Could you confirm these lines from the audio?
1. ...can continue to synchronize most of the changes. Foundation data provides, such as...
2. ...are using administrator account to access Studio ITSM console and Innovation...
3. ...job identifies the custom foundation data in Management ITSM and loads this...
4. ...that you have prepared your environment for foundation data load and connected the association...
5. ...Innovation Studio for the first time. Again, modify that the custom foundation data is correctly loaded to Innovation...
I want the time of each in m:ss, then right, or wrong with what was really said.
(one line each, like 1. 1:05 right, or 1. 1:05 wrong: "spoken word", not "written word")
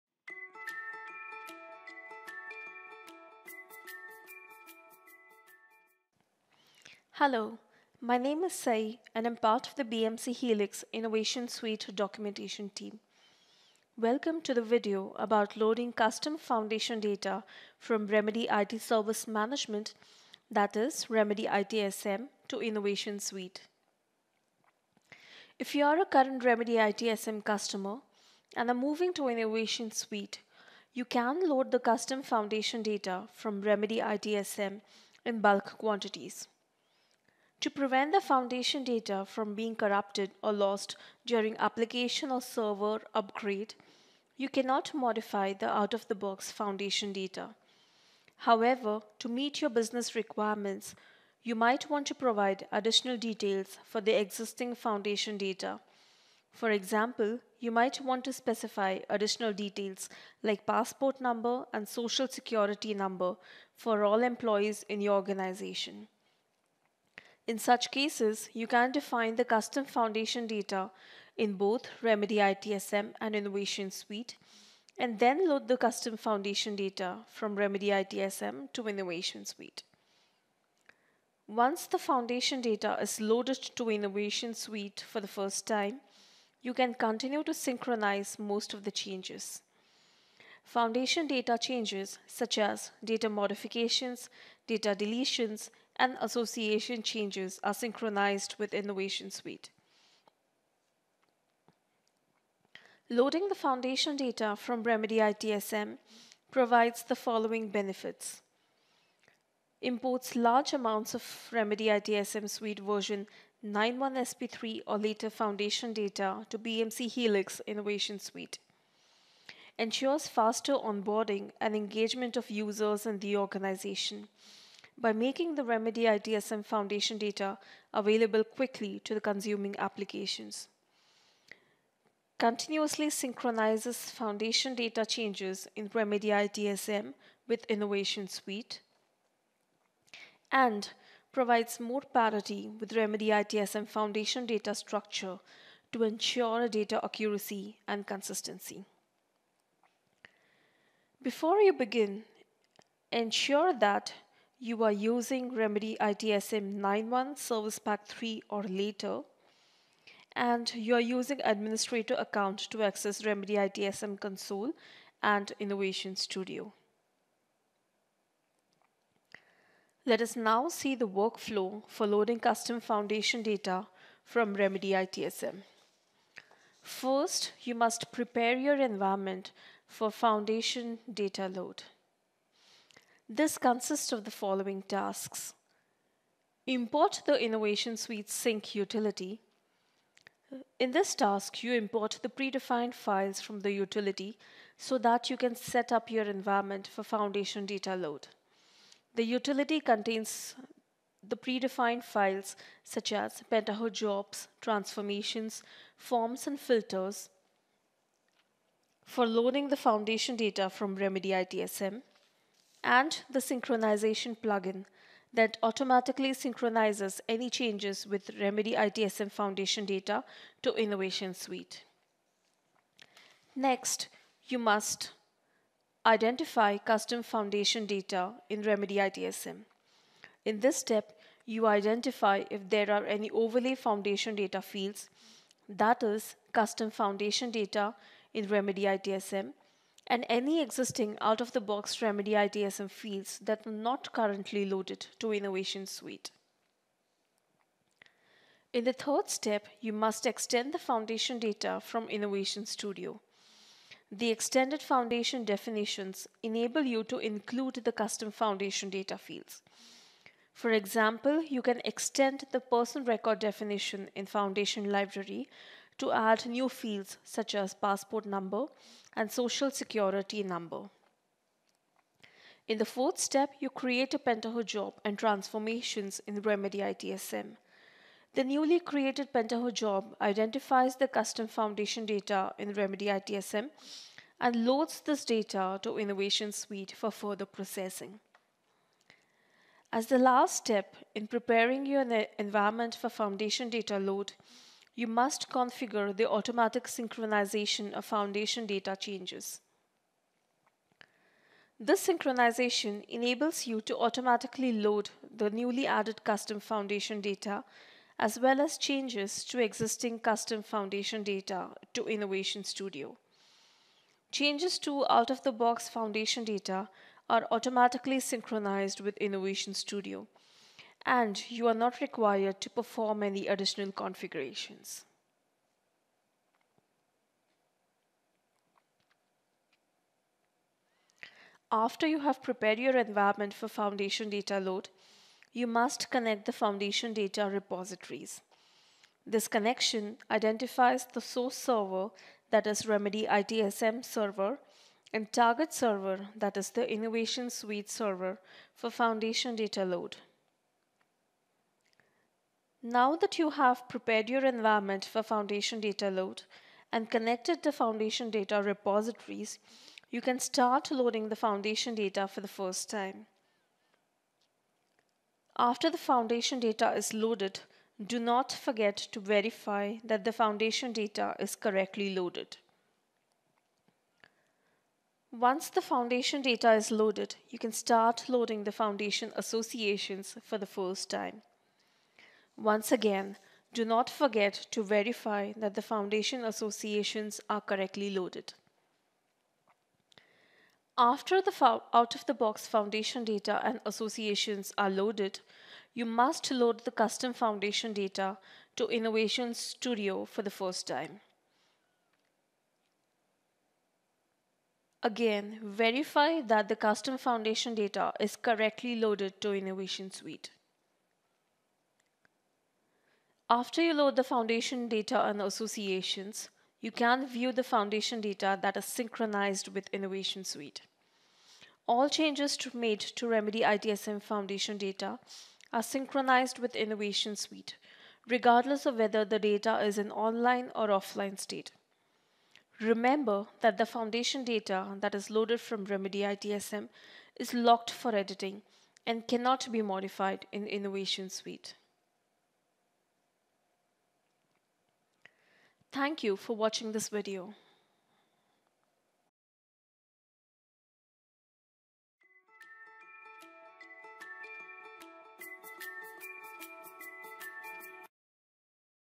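1. 1:26 wrong: "changes", not "provides"
2. 2:40 wrong: "Remedy", not "Studio"
3. 4:39 wrong: "Remedy", not "Management"
4. 5:53 wrong: "foundation", not "association"
5. 6:38 wrong: "verify", not "modify".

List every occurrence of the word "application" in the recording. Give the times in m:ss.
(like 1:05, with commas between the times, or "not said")
0:41, 2:09.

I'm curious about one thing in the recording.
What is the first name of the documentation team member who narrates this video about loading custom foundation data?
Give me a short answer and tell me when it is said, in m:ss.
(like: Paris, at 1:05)
Sayee, at 0:08.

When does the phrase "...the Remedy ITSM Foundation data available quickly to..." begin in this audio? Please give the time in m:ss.
2:05.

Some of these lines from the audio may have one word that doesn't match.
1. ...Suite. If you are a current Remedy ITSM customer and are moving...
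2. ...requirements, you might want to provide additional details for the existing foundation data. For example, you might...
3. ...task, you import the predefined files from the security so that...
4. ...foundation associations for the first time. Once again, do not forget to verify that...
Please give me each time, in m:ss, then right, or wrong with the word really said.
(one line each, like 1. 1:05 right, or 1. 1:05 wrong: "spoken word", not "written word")
1. 0:23 right
2. 0:50 right
3. 3:11 wrong: "utility", not "security"
4. 6:18 right.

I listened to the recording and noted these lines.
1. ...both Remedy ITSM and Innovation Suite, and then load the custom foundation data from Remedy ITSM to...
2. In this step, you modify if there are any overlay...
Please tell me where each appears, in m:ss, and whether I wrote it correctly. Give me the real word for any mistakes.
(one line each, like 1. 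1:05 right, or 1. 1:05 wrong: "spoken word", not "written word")
1. 1:11 right
2. 3:50 wrong: "identify", not "modify".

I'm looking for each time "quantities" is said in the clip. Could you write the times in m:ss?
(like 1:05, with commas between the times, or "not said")
0:35.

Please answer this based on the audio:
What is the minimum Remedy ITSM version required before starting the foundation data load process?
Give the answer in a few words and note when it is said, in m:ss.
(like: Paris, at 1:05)
9.1 Service Pack 3, at 2:36.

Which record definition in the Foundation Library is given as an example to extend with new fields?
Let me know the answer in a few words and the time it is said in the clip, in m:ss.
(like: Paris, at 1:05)
person record definition, at 4:22.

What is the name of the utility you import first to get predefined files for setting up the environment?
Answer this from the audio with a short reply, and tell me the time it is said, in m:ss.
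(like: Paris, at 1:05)
Innovation Suite Sync utility, at 3:07.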